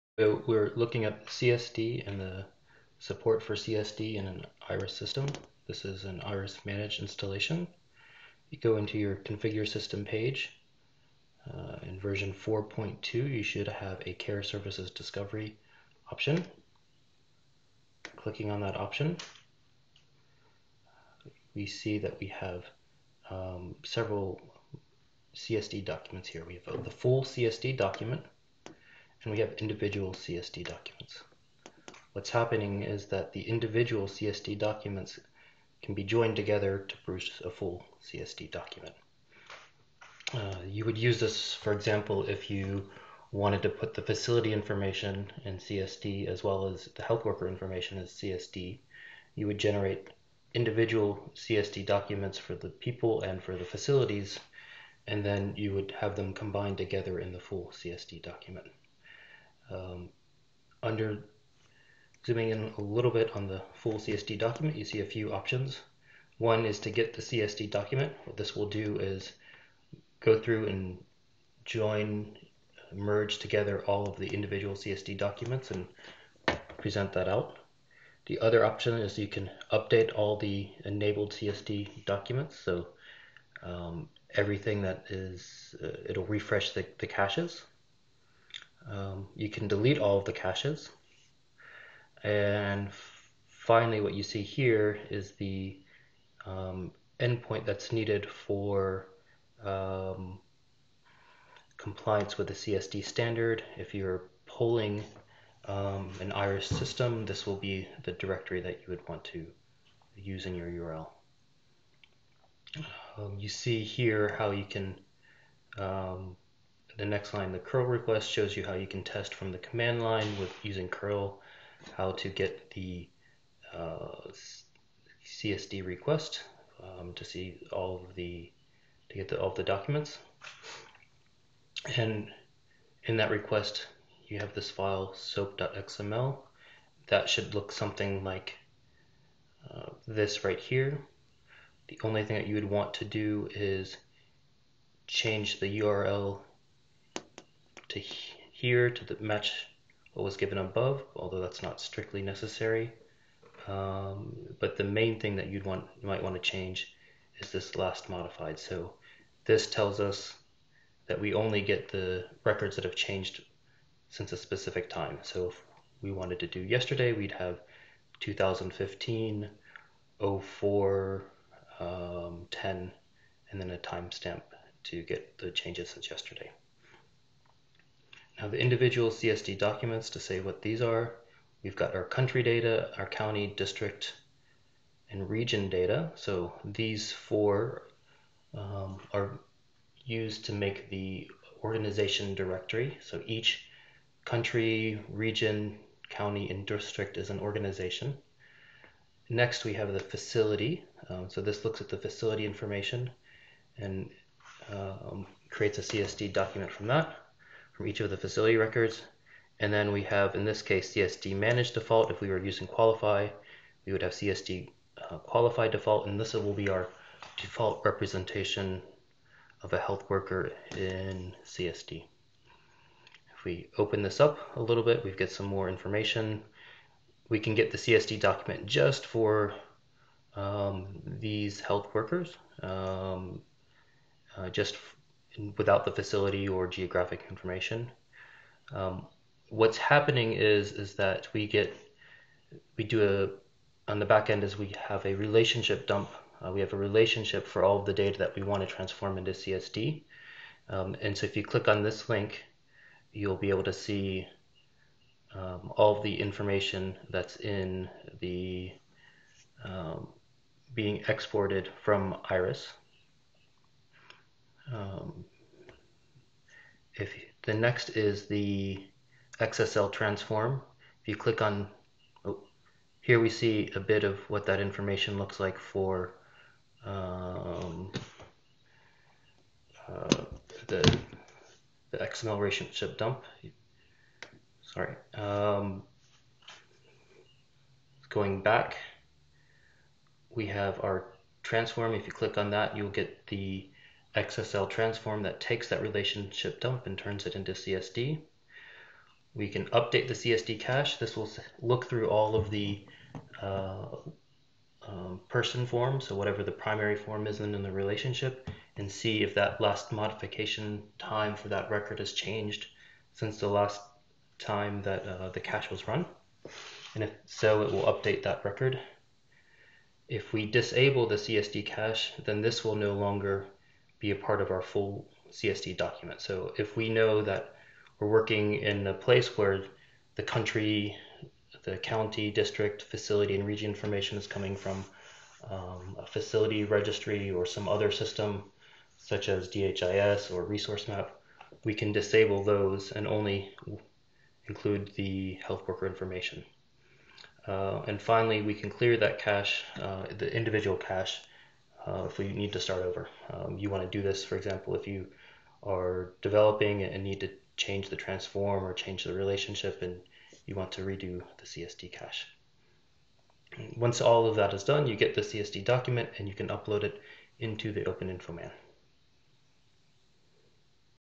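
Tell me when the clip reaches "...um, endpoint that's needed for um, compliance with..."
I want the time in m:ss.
1:36.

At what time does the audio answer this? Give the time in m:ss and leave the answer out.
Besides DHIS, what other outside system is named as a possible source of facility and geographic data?
5:40.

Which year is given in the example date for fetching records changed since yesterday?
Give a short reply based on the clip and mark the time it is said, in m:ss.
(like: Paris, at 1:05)
2015, at 2:48.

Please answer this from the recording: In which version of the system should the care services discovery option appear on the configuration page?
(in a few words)
4.2.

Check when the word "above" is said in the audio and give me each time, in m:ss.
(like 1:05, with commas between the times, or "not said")
2:30.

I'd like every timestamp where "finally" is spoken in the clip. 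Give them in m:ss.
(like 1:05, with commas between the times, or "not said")
1:33, 5:48.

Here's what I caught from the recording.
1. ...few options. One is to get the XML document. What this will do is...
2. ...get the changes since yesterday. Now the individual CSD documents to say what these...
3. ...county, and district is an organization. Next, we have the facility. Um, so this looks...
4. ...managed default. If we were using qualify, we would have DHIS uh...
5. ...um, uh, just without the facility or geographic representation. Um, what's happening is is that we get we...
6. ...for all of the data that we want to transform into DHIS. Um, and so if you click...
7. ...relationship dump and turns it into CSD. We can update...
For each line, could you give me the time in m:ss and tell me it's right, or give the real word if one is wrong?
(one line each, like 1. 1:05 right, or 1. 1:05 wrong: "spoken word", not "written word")
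1. 1:05 wrong: "CSD", not "XML"
2. 2:55 right
3. 3:16 right
4. 3:31 wrong: "CSD", not "DHIS"
5. 3:52 wrong: "information", not "representation"
6. 4:07 wrong: "CSD", not "DHIS"
7. 4:55 right.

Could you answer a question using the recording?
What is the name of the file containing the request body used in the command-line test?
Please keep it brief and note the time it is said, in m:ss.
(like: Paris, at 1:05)
soap.xml, at 2:15.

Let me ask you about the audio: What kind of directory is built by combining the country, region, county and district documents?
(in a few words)
organization directory.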